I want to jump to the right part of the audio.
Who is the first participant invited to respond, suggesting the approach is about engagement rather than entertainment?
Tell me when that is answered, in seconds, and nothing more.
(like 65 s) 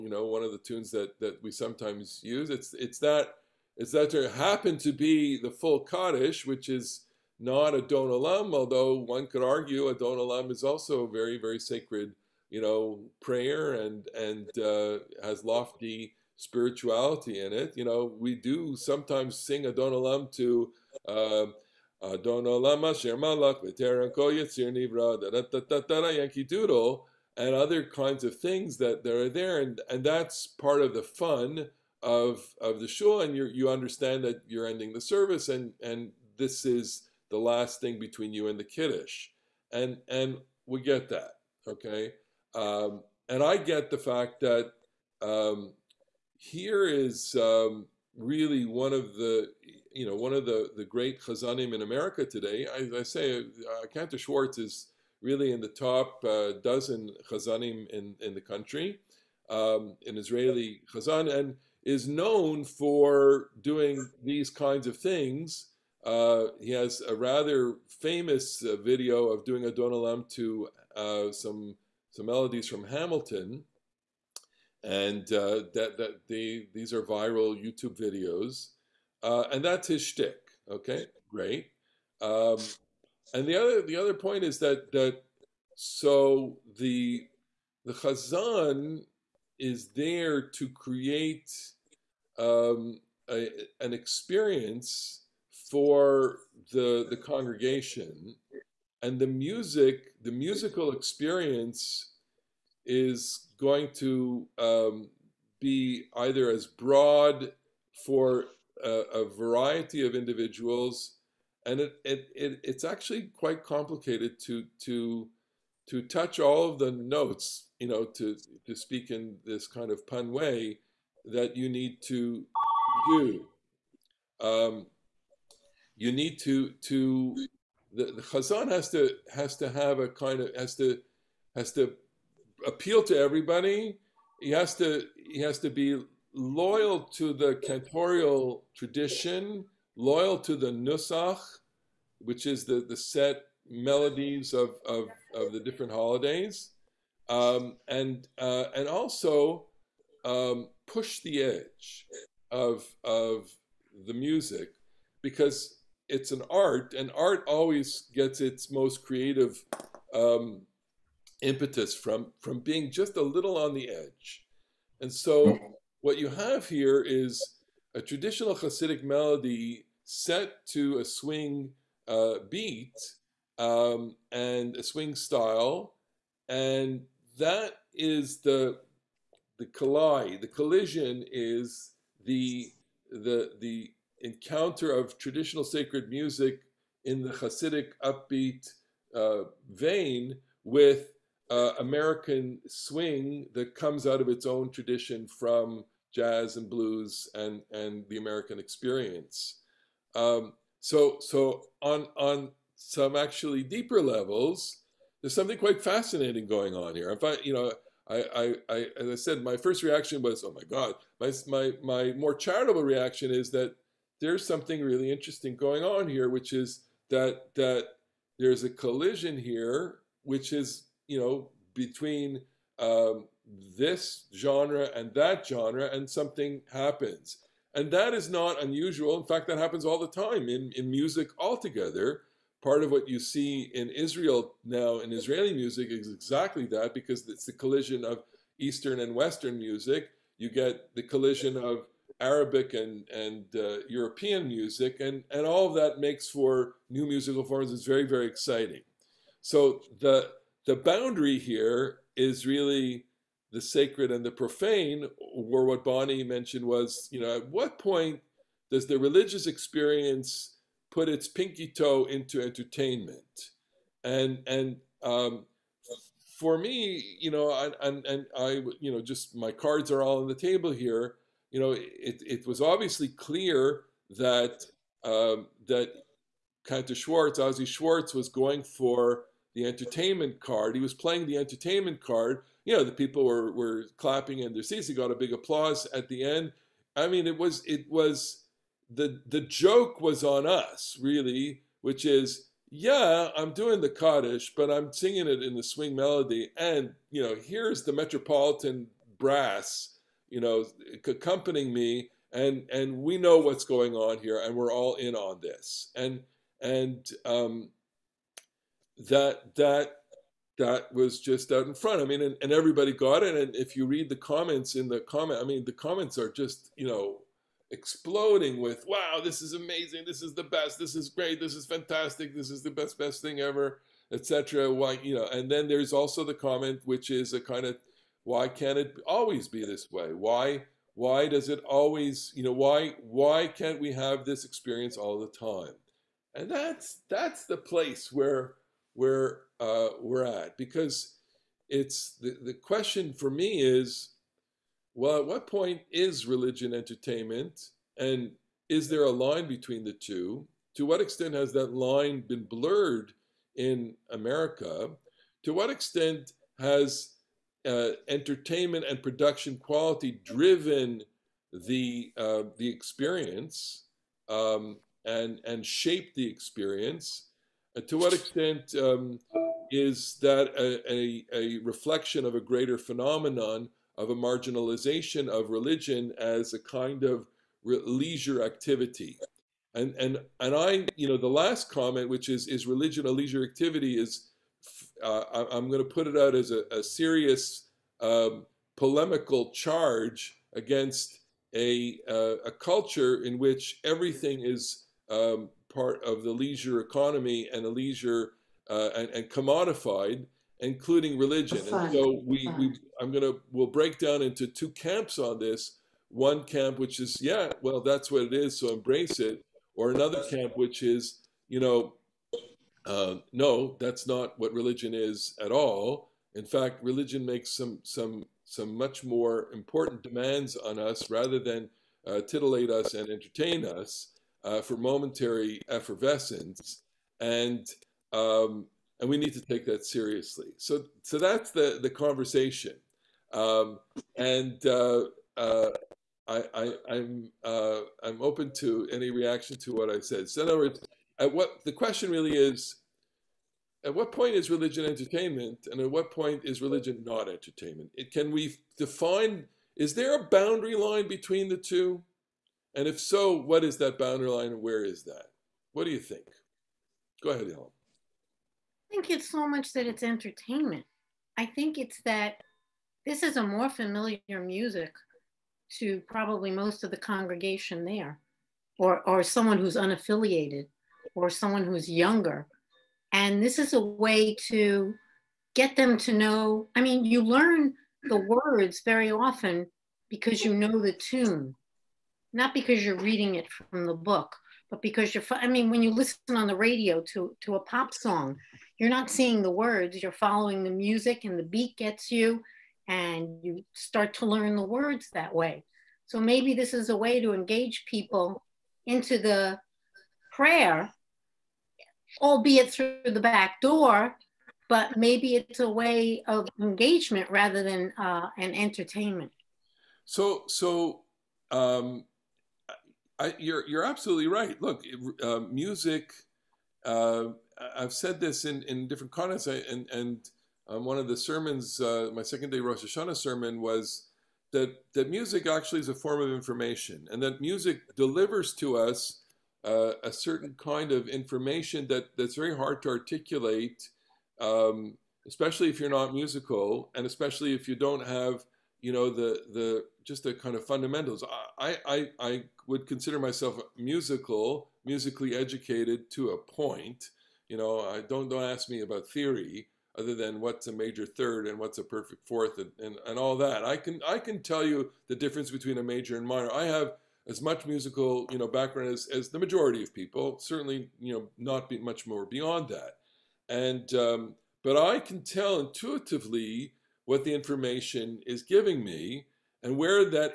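457 s.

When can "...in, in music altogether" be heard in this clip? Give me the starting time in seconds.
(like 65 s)
230 s.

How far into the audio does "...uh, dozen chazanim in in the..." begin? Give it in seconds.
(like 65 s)
56 s.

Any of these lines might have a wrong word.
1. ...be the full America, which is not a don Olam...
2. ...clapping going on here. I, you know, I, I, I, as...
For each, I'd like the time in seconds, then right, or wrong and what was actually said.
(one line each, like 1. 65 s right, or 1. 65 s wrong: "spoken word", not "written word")
1. 4 s wrong: "Kaddish", not "America"
2. 205 s wrong: "fascinating", not "clapping".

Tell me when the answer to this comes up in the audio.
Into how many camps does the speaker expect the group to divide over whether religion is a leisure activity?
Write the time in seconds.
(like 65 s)
404 s.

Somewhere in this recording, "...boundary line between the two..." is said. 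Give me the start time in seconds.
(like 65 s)
450 s.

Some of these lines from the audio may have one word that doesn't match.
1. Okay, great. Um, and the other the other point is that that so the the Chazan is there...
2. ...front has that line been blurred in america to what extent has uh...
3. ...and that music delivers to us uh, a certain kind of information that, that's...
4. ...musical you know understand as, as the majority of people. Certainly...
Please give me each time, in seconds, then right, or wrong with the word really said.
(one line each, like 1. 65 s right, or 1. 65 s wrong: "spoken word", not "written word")
1. 80 s right
2. 350 s wrong: "extent", not "front"
3. 527 s right
4. 557 s wrong: "background", not "understand".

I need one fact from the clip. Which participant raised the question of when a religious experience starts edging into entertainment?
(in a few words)
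Bonnie.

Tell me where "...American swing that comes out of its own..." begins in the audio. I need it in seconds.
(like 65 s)
191 s.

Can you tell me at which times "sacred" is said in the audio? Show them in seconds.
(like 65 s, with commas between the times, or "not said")
11 s, 185 s, 253 s.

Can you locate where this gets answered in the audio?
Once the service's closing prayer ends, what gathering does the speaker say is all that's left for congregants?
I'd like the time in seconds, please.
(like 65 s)
38 s.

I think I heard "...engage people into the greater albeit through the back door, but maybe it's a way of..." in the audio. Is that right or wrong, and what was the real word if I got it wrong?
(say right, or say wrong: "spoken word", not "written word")
wrong: "prayer", not "greater".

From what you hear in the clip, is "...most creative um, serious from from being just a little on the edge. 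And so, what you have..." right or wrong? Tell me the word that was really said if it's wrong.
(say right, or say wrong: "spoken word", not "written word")
wrong: "impetus", not "serious".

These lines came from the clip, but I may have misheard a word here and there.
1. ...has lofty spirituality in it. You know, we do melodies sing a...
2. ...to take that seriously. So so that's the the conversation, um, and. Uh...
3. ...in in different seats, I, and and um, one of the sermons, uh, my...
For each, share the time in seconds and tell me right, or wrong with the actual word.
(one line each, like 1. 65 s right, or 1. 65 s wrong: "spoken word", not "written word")
1. 15 s wrong: "sometimes", not "melodies"
2. 429 s right
3. 518 s wrong: "contexts", not "seats".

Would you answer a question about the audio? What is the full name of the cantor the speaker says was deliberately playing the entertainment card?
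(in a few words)
Azi Schwartz.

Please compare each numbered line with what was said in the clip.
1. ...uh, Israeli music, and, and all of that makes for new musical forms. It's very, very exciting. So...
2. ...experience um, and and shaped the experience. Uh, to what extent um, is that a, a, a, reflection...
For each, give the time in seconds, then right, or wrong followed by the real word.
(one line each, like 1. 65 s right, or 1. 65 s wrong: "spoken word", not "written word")
1. 243 s wrong: "European", not "Israeli"
2. 362 s right.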